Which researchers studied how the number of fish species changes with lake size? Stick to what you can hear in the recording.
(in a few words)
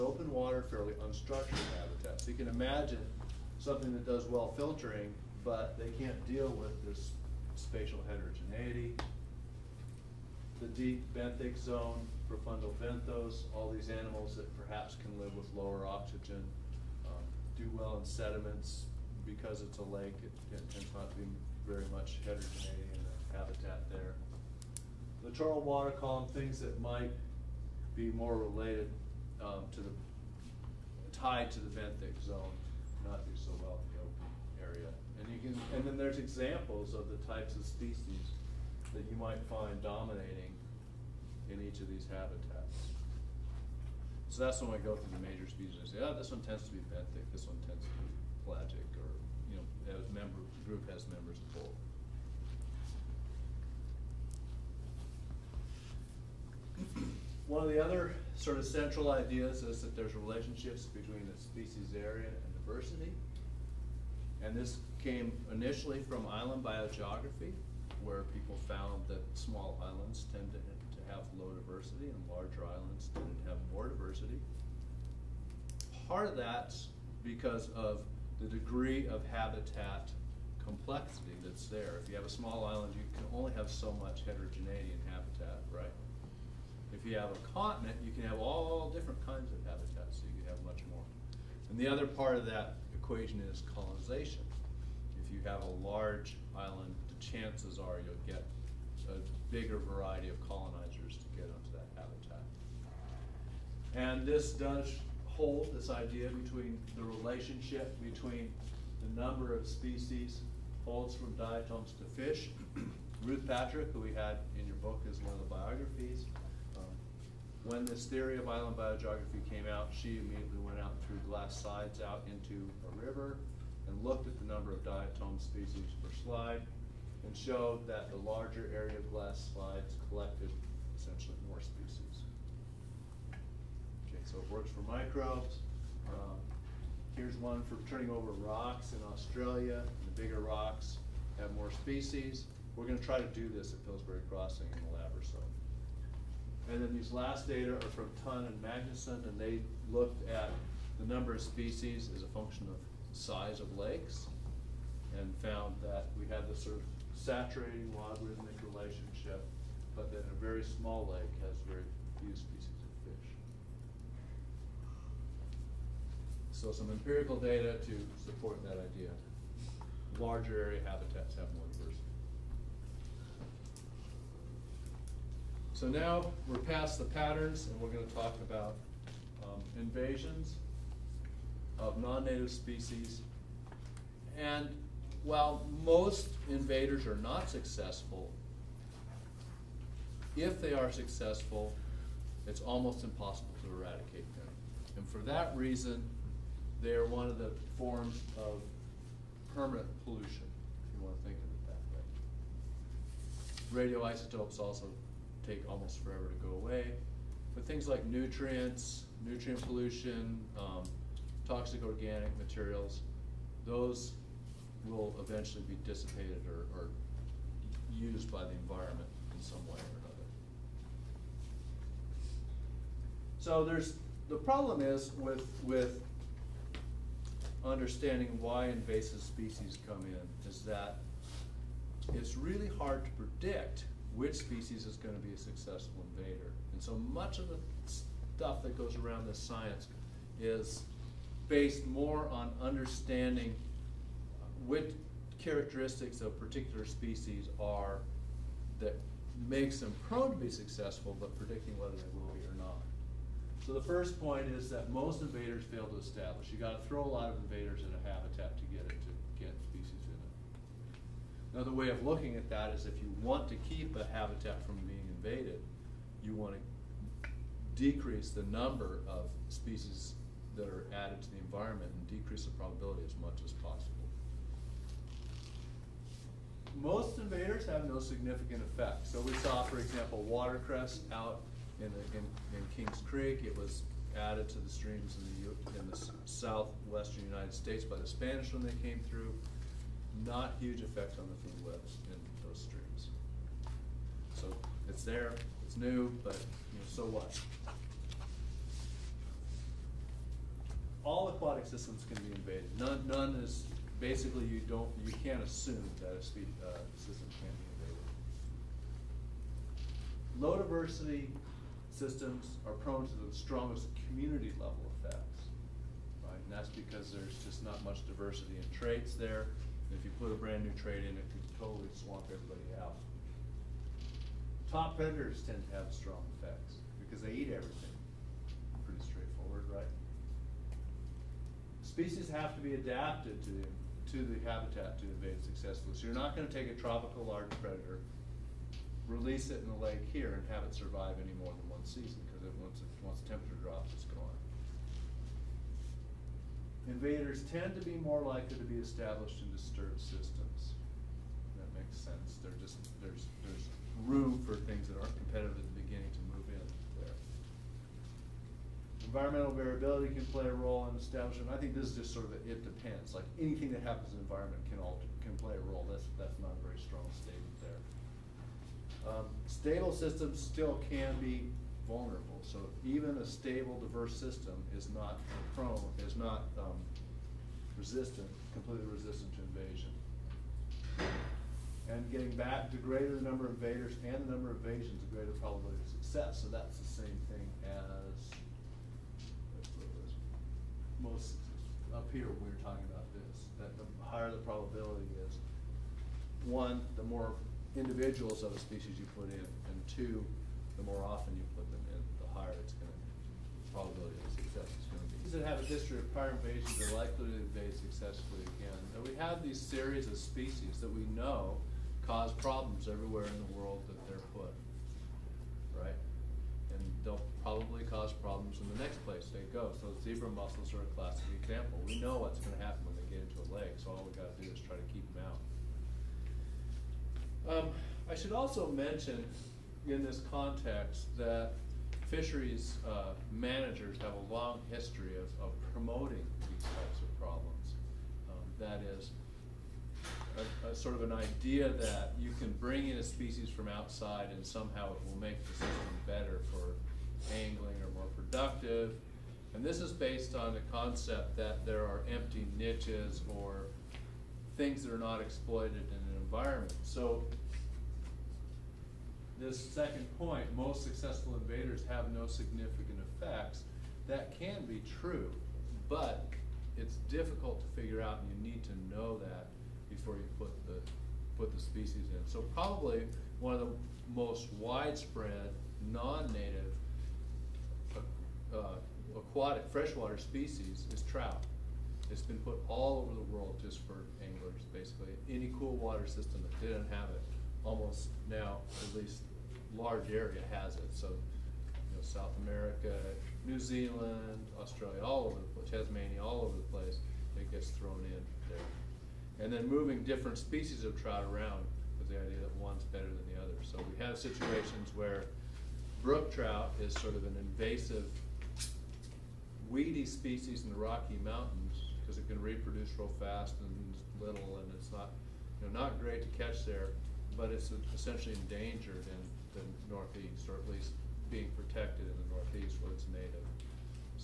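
Tonn and Magnuson.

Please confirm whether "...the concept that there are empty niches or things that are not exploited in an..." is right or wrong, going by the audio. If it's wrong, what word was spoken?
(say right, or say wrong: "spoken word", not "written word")
right.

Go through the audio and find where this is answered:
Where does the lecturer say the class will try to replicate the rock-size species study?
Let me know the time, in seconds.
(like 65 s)
143 s.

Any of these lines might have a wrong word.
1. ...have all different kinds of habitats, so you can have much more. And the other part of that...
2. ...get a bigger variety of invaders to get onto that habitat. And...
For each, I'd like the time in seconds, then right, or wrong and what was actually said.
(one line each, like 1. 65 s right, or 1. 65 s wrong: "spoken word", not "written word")
1. 88 s right
2. 98 s wrong: "colonizers", not "invaders".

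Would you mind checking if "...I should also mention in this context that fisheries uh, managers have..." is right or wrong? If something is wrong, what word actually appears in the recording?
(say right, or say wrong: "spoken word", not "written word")
right.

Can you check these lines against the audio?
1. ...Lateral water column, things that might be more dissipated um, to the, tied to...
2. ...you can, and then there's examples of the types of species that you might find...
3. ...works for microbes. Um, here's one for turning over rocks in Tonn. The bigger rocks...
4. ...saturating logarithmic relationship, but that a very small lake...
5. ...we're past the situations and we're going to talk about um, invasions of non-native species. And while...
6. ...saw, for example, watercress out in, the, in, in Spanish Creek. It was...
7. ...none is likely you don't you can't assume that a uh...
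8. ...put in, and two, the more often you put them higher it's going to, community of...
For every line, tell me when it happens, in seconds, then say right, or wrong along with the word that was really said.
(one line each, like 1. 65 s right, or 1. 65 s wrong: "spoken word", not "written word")
1. 25 s wrong: "related", not "dissipated"
2. 35 s right
3. 134 s wrong: "Australia", not "Tonn"
4. 157 s right
5. 176 s wrong: "patterns", not "situations"
6. 279 s wrong: "Kings", not "Spanish"
7. 303 s wrong: "basically", not "likely"
8. 399 s wrong: "probability", not "community".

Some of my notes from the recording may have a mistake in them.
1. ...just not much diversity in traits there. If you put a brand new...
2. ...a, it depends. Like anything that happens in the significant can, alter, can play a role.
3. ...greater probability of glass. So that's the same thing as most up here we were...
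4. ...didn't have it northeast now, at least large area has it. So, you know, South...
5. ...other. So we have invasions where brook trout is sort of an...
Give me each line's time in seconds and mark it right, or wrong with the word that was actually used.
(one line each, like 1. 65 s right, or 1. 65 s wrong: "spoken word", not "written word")
1. 317 s right
2. 362 s wrong: "environment", not "significant"
3. 385 s wrong: "success", not "glass"
4. 486 s wrong: "almost", not "northeast"
5. 503 s wrong: "situations", not "invasions".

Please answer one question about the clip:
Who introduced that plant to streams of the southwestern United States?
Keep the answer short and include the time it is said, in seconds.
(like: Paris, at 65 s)
the Spanish, at 287 s.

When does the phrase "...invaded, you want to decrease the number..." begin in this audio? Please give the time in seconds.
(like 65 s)
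265 s.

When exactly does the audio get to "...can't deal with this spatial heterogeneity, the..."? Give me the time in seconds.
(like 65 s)
6 s.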